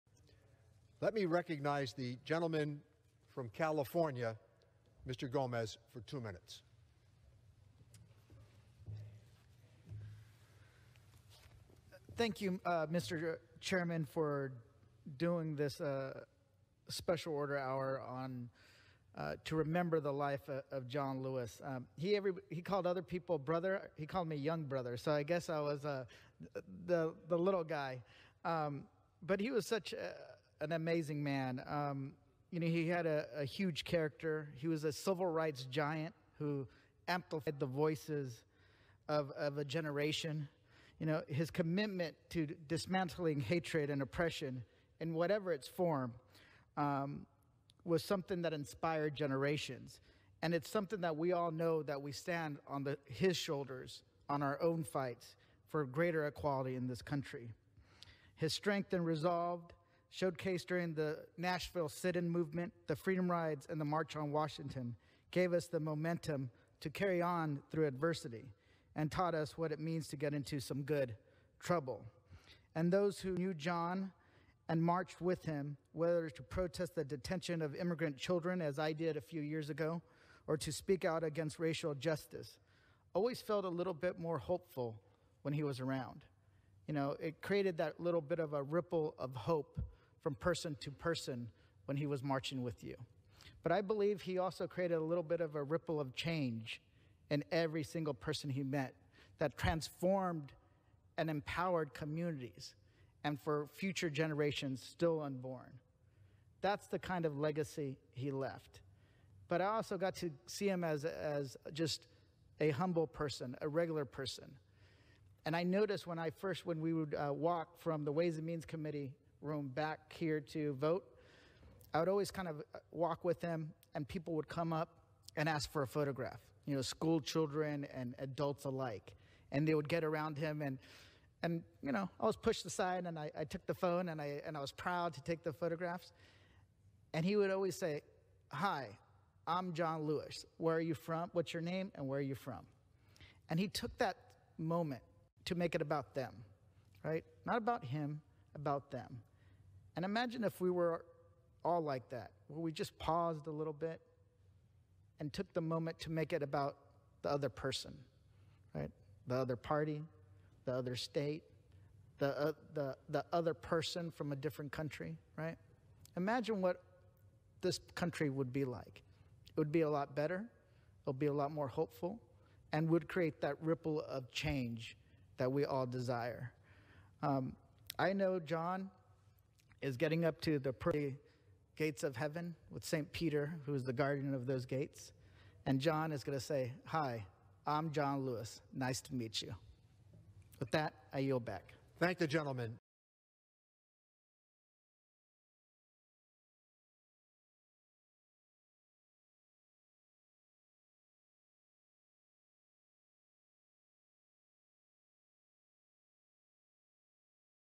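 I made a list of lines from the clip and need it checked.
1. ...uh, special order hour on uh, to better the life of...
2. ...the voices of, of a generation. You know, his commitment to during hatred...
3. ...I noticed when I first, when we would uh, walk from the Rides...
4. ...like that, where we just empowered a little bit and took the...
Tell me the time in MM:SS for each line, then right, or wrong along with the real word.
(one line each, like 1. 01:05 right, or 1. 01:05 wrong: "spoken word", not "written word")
1. 00:15 wrong: "remember", not "better"
2. 00:37 wrong: "dismantling", not "during"
3. 01:55 wrong: "Ways", not "Rides"
4. 02:31 wrong: "paused", not "empowered".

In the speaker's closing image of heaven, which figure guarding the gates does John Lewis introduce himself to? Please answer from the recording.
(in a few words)
St. Peter.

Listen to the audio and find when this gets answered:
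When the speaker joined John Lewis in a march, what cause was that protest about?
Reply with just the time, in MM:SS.
01:17.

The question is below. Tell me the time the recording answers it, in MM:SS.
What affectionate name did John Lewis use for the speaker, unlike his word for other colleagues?
00:24.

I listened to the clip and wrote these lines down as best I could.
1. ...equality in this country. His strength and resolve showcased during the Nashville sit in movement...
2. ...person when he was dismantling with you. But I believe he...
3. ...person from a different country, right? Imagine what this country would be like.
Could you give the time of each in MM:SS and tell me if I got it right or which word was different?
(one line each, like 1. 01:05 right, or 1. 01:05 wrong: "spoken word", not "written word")
1. 00:56 right
2. 01:30 wrong: "marching", not "dismantling"
3. 02:43 right.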